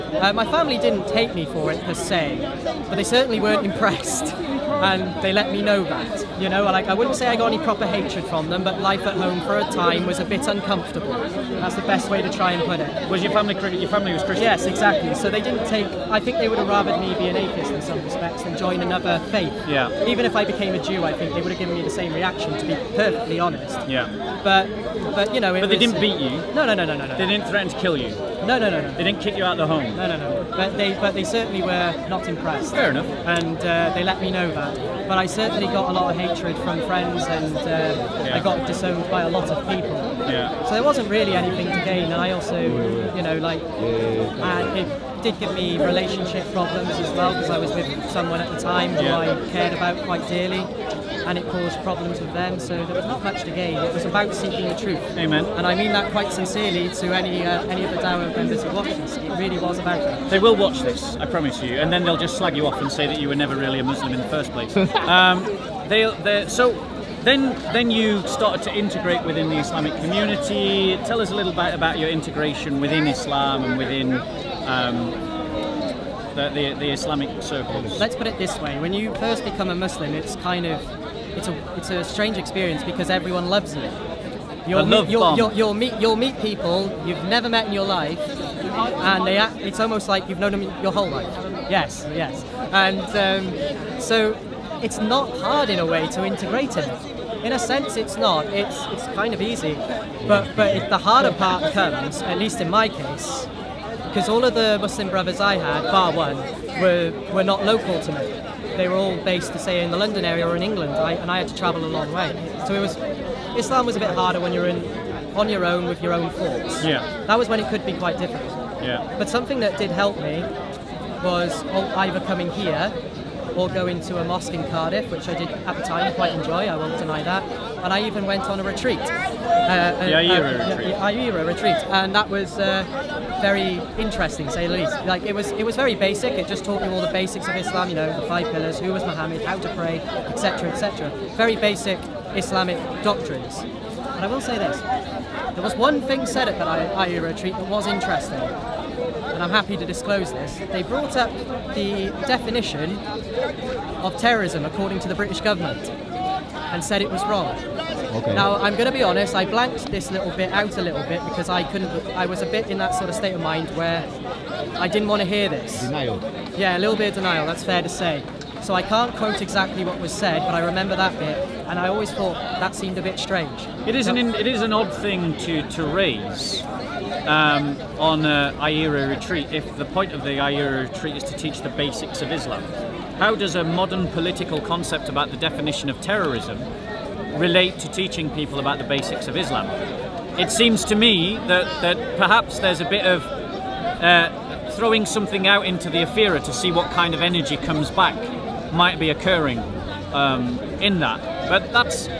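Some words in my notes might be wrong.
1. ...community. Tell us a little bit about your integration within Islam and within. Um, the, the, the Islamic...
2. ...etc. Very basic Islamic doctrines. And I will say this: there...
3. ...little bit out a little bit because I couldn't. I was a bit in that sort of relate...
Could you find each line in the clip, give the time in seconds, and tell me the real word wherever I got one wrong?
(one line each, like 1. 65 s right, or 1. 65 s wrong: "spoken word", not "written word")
1. 69 s right
2. 140 s right
3. 160 s wrong: "state", not "relate".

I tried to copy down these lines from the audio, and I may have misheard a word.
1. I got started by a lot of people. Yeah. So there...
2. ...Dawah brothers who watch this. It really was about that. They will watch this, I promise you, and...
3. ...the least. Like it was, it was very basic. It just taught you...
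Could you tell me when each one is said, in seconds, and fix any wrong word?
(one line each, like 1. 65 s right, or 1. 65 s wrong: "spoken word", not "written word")
1. 38 s wrong: "disowned", not "started"
2. 57 s wrong: "members", not "brothers"
3. 134 s right.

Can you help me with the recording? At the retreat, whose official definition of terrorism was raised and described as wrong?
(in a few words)
British government.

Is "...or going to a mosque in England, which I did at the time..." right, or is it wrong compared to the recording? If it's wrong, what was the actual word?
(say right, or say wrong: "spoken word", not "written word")
wrong: "Cardiff", not "England".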